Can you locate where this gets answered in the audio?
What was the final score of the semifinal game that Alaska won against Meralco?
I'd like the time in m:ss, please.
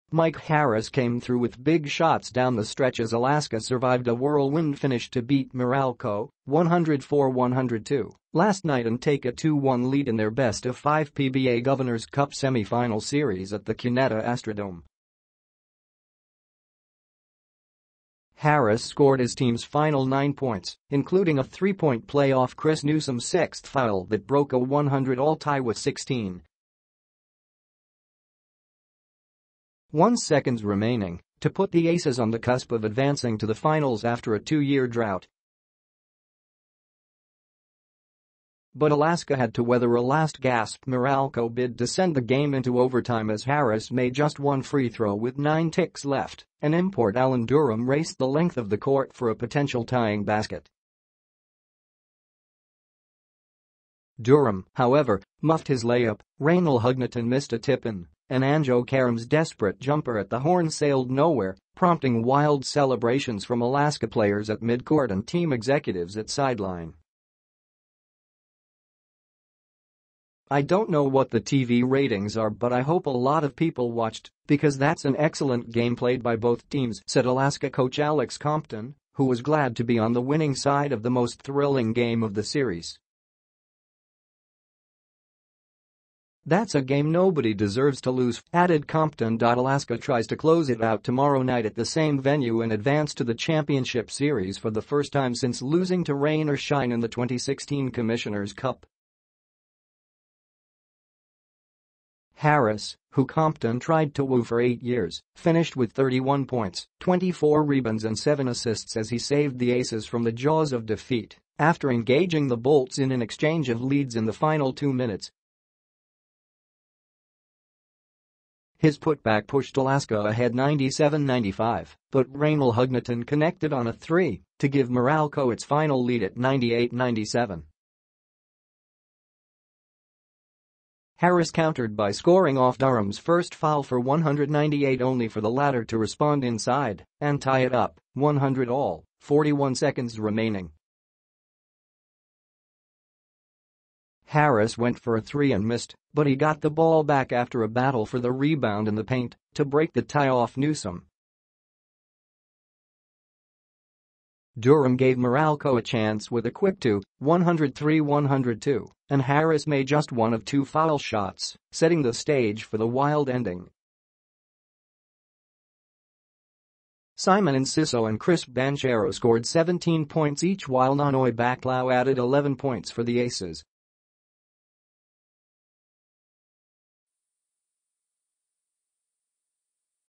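0:06.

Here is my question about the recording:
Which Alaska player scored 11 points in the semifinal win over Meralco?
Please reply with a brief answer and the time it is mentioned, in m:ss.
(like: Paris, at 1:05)
Nonoy Baclao, at 2:50.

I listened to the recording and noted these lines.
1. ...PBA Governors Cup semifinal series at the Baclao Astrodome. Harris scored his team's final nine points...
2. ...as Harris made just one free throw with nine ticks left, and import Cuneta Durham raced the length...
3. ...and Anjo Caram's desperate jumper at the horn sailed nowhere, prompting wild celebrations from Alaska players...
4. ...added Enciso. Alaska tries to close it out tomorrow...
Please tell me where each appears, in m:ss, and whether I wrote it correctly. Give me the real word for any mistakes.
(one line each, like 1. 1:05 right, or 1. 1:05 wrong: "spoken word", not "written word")
1. 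0:11 wrong: "Cuneta", not "Baclao"
2. 0:43 wrong: "Allen", not "Cuneta"
3. 0:58 right
4. 1:28 wrong: "Compton", not "Enciso".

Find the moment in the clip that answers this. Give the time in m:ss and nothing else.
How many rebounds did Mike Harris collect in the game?
1:47.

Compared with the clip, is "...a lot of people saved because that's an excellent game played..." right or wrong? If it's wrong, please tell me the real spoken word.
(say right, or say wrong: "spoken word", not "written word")
wrong: "watched", not "saved".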